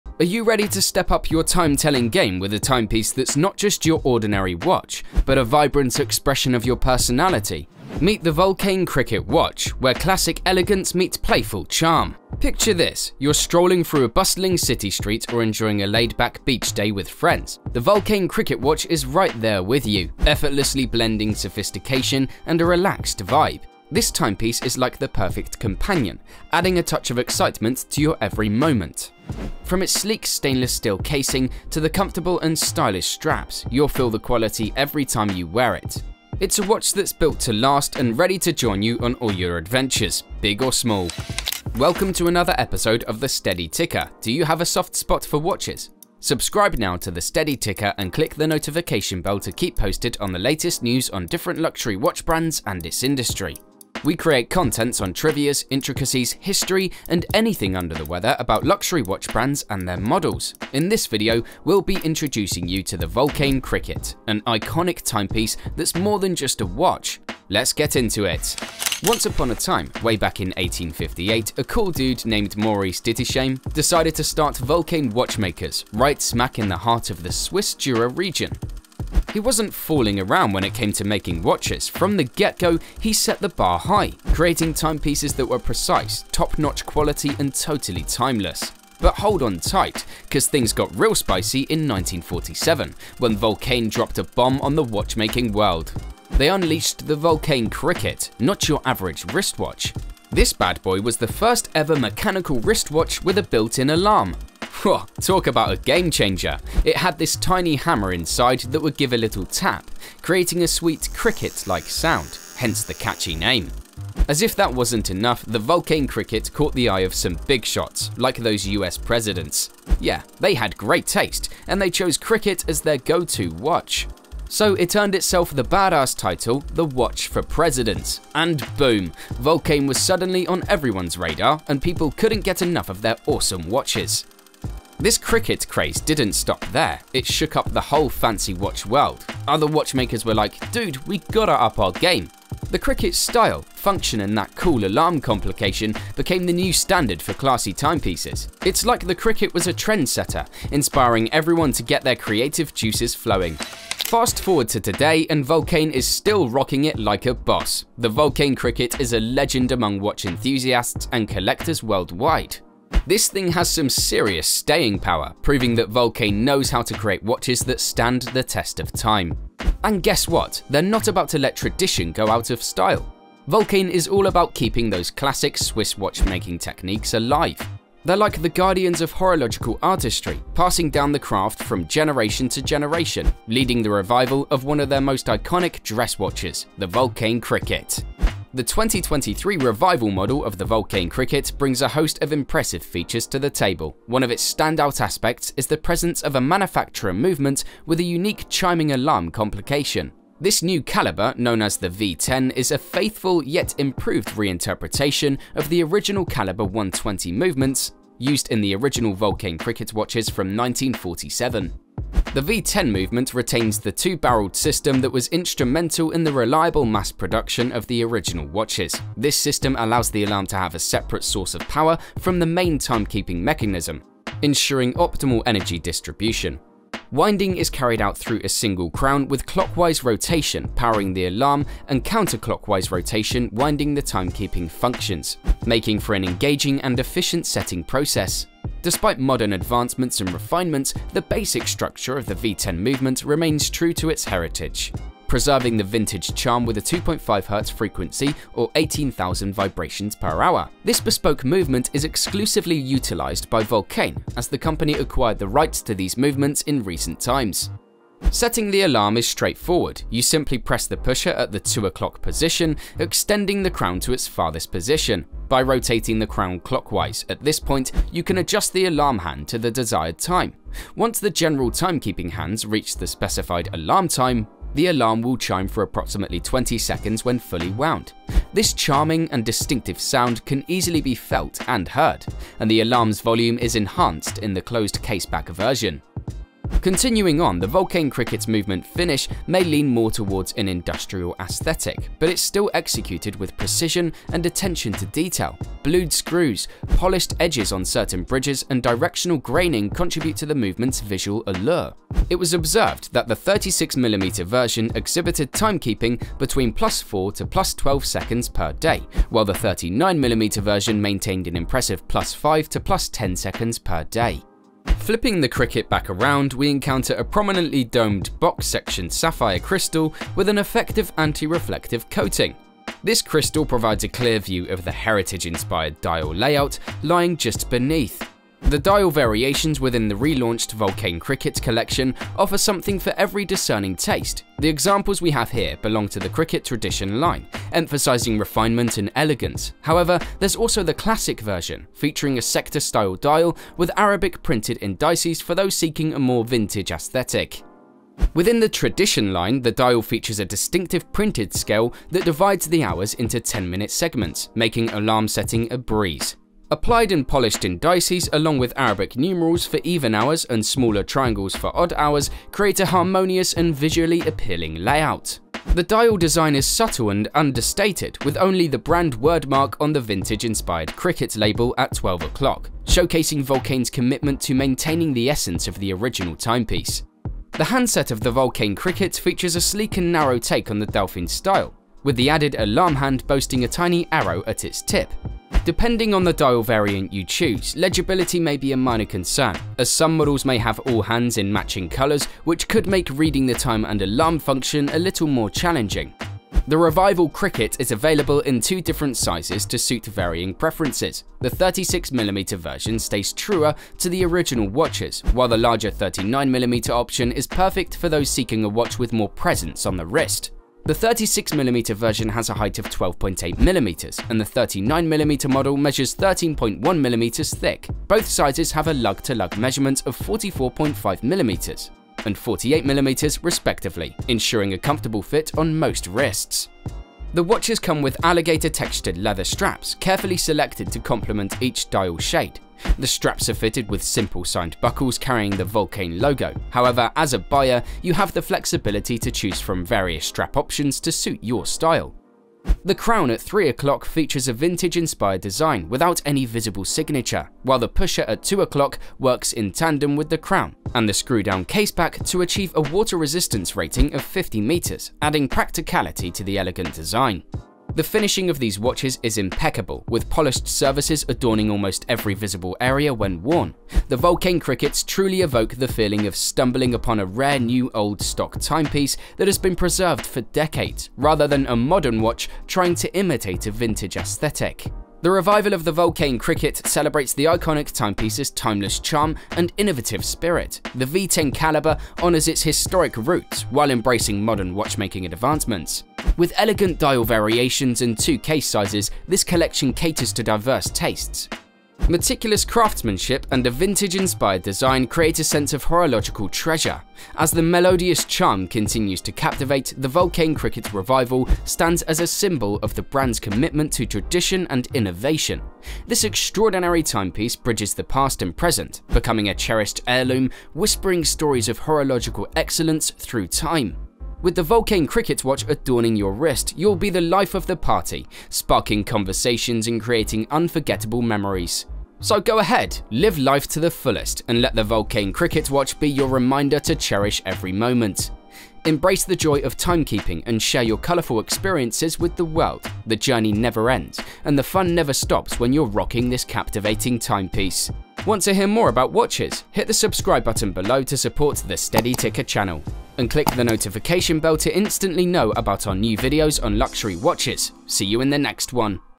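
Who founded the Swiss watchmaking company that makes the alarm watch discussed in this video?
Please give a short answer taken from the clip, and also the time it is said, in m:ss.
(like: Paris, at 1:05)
Maurice Ditisheim, at 1:12.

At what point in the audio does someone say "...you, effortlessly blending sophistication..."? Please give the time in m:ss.
0:19.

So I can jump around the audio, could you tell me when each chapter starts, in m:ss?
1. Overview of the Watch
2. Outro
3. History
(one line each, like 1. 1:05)
1. 3:08
2. 7:56
3. 1:09.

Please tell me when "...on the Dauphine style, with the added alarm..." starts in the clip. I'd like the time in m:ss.
6:20.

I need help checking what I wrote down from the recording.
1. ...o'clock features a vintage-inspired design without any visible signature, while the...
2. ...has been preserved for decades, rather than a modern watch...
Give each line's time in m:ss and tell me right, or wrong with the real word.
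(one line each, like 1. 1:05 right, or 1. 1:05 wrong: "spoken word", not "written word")
1. 7:23 right
2. 7:49 right.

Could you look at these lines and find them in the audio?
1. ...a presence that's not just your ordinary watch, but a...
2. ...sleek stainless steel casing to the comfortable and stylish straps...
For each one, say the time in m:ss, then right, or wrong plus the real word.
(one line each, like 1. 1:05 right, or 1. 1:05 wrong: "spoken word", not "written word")
1. 0:02 wrong: "timepiece", not "presence"
2. 0:29 right.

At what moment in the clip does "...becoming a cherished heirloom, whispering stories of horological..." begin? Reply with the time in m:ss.
8:29.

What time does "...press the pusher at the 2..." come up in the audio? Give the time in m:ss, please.
4:20.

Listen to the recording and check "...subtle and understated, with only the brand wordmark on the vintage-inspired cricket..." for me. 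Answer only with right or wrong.
right.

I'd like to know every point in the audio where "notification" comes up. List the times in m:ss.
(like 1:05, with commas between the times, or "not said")
0:48, 9:03.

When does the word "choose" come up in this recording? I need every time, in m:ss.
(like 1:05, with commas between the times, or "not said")
6:27, 7:19.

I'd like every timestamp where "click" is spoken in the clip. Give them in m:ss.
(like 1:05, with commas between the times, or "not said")
0:48, 9:03.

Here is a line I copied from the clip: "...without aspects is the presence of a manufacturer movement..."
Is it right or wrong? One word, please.
wrong.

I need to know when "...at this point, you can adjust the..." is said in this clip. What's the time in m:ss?
4:27.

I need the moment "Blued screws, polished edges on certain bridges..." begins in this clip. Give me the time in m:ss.
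4:55.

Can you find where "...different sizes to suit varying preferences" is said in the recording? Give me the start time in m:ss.
6:38.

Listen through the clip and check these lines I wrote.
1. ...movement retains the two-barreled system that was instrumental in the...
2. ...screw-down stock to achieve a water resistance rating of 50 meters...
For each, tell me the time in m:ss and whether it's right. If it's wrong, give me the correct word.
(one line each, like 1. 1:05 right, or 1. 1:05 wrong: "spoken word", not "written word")
1. 3:32 right
2. 7:31 wrong: "caseback", not "stock".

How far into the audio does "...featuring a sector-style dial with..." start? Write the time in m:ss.
5:41.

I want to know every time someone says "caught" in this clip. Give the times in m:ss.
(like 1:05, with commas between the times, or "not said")
1:56.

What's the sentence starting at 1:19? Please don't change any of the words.
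He wasn't fooling around when it came to making watches.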